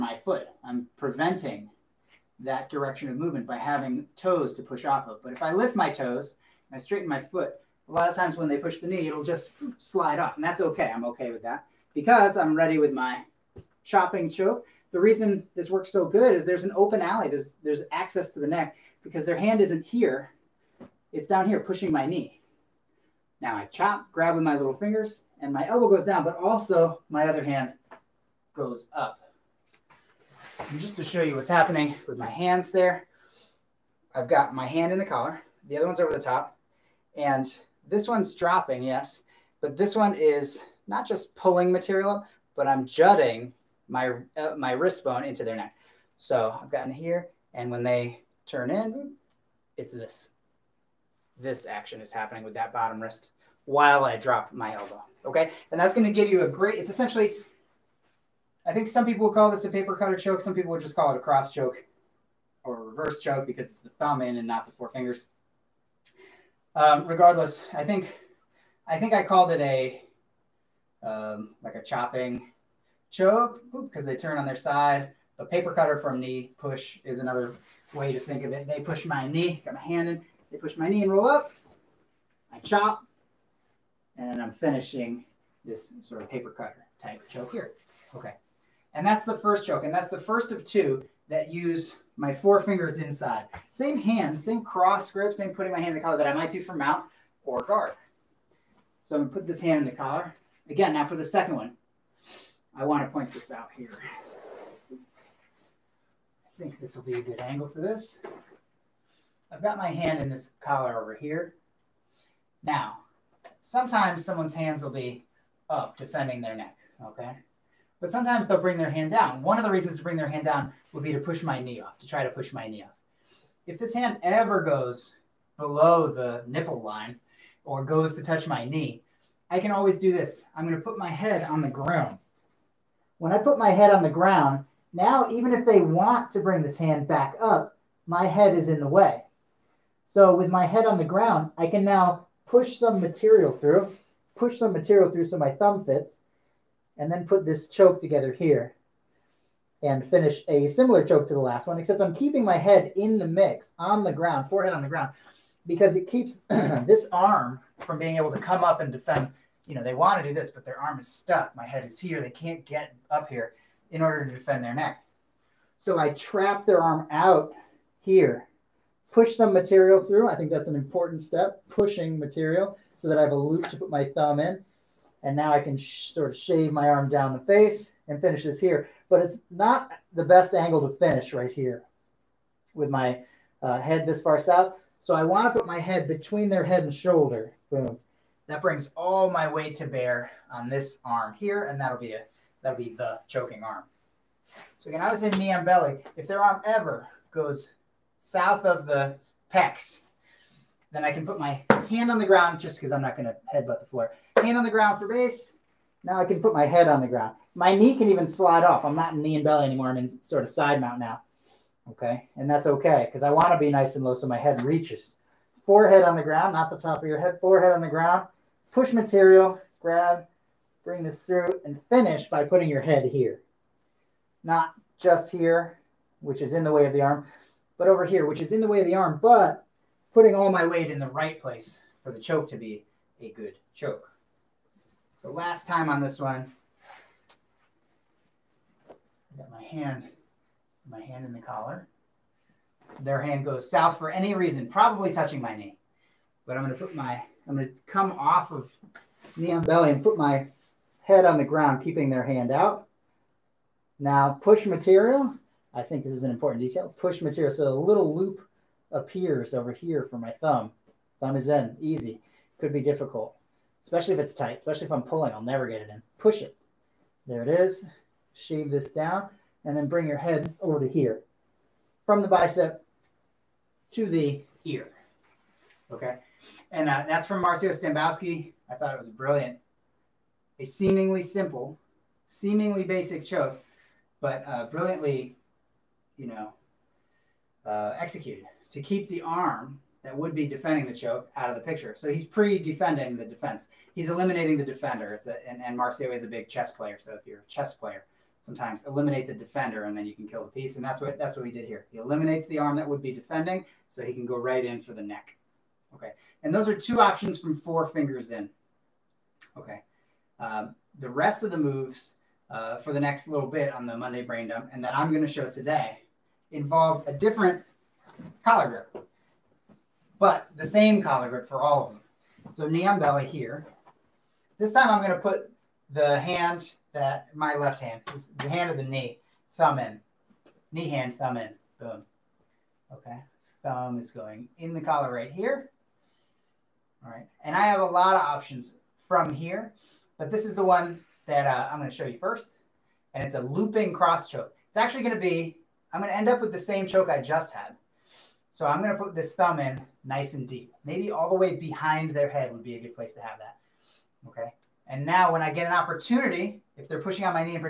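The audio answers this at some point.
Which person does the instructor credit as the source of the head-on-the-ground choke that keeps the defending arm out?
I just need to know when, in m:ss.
4:37.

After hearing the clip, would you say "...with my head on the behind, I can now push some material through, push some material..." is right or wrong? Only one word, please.
wrong.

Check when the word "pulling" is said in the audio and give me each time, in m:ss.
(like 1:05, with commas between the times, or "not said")
0:41, 4:25.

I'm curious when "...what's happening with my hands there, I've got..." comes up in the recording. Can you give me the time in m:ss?
0:31.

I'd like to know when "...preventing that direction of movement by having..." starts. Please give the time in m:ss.
0:00.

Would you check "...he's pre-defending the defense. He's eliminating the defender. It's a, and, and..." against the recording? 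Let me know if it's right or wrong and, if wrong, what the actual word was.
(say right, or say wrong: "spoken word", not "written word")
right.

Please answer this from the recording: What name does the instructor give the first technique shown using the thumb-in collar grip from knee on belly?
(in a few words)
looping cross choke.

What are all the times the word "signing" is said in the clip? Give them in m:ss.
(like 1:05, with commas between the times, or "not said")
not said.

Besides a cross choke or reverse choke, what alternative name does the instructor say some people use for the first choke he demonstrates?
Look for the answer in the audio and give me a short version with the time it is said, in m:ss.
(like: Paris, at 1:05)
paper cutter choke, at 0:59.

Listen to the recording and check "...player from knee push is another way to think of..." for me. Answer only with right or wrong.
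wrong.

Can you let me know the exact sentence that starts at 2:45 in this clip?
So I trap their arm out here push some material through.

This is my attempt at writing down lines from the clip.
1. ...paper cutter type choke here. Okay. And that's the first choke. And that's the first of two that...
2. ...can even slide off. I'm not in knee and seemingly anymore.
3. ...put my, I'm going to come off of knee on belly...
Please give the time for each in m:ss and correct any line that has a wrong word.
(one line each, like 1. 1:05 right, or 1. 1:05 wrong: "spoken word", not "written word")
1. 1:26 right
2. 3:27 wrong: "belly", not "seemingly"
3. 4:06 right.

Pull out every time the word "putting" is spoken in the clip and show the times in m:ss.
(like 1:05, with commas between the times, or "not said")
1:35, 3:42, 3:50.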